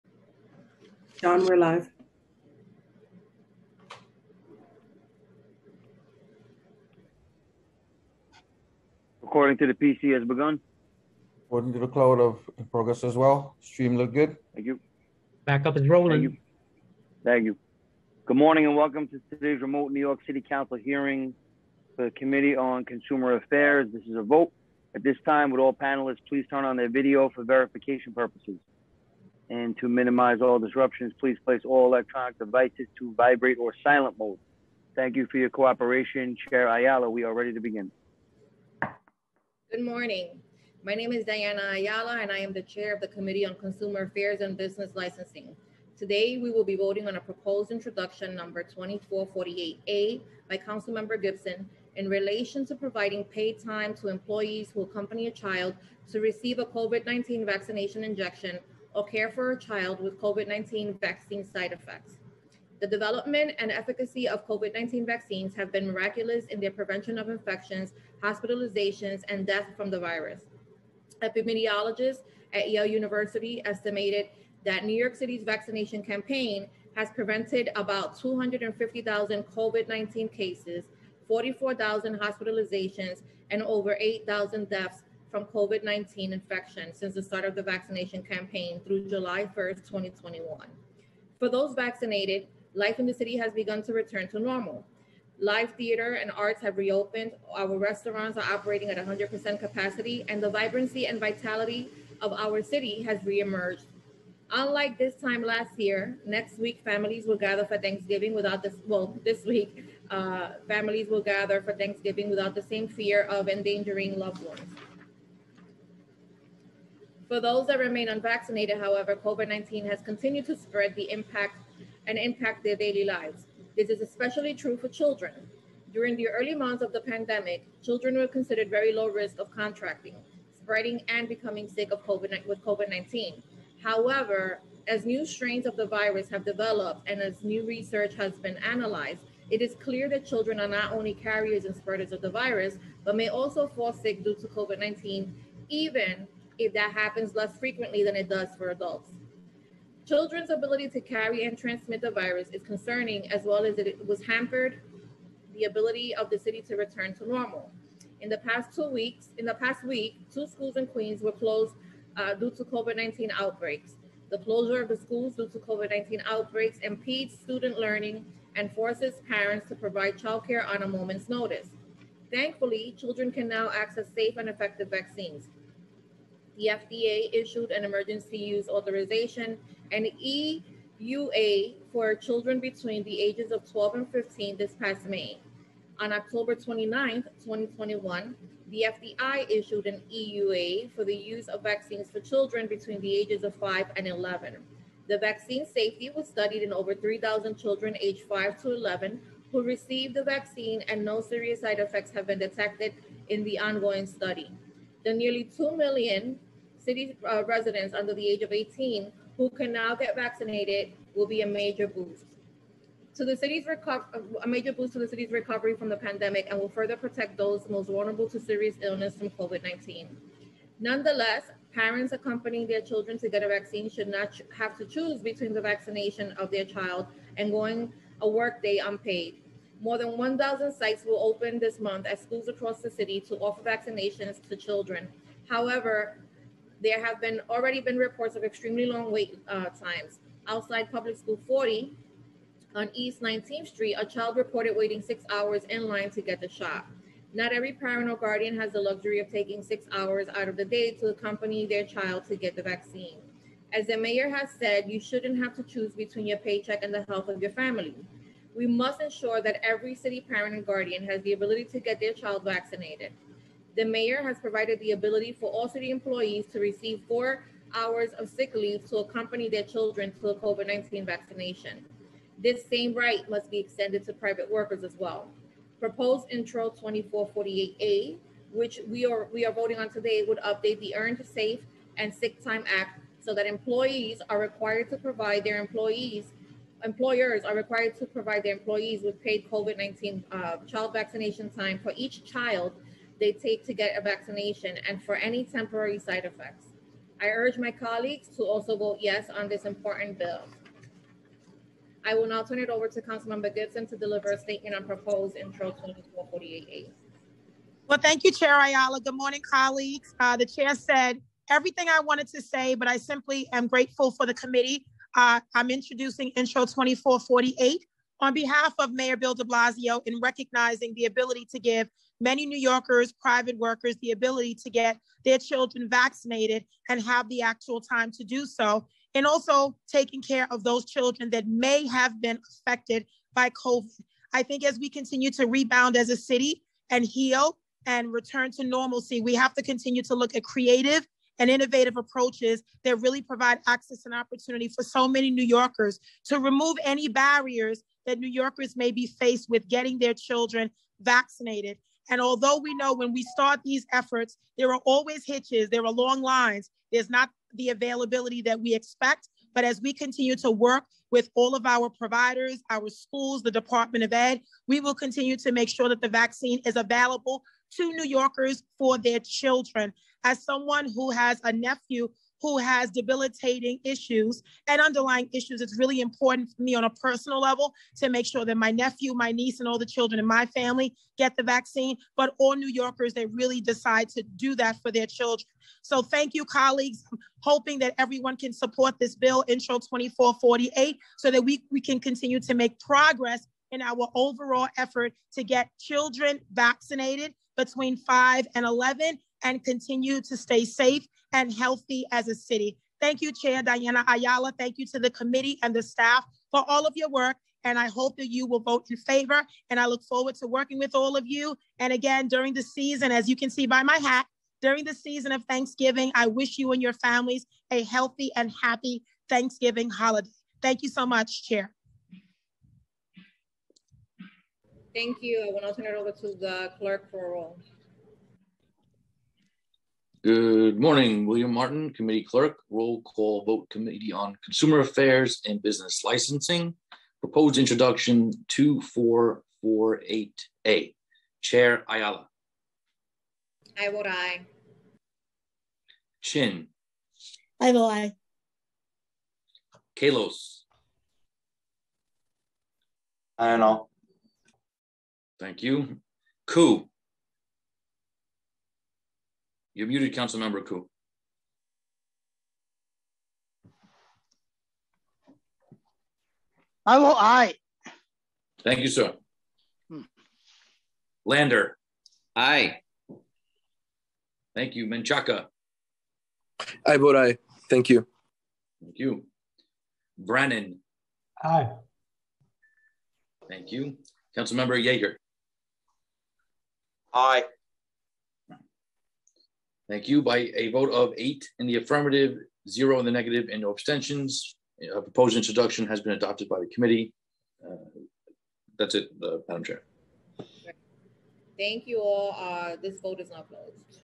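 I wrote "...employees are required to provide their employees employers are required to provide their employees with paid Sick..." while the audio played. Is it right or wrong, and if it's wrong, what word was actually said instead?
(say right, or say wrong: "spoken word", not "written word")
wrong: "COVID", not "Sick".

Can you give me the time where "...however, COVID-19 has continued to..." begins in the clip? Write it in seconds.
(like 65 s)
118 s.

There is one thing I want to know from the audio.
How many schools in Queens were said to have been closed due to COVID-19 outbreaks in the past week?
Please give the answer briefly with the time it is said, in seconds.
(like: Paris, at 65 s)
2, at 160 s.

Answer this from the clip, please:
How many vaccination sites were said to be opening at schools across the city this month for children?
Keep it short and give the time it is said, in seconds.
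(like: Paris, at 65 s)
More than 1,000, at 229 s.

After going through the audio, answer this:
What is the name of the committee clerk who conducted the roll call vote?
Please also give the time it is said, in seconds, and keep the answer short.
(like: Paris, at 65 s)
William Martin, at 431 s.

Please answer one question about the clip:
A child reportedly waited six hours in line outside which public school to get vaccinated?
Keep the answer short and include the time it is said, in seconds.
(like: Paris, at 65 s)
Public School 40, at 240 s.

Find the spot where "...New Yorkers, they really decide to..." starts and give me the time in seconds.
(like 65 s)
382 s.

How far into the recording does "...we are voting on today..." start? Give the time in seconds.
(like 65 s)
279 s.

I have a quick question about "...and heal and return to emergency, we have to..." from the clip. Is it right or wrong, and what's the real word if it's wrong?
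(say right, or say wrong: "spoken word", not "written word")
wrong: "normalcy", not "emergency".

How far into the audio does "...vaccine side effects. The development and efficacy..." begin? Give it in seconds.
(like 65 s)
60 s.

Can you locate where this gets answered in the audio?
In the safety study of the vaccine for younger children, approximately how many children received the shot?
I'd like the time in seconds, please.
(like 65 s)
196 s.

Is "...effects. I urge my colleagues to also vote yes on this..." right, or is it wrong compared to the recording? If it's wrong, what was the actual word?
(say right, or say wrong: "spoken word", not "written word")
right.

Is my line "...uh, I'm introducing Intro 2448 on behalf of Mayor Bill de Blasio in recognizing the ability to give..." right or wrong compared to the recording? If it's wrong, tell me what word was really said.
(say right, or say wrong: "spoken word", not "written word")
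right.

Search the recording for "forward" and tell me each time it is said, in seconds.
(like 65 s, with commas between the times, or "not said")
410 s.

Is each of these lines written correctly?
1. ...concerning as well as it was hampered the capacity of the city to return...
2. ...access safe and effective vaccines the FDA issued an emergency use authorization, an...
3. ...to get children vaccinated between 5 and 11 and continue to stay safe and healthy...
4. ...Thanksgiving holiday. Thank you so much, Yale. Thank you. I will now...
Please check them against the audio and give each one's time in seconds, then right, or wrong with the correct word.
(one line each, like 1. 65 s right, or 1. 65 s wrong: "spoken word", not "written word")
1. 152 s wrong: "ability", not "capacity"
2. 173 s right
3. 395 s right
4. 419 s wrong: "Chair", not "Yale".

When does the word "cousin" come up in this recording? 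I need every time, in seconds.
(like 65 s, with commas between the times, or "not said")
not said.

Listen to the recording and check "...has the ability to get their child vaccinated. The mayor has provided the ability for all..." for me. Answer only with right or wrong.
right.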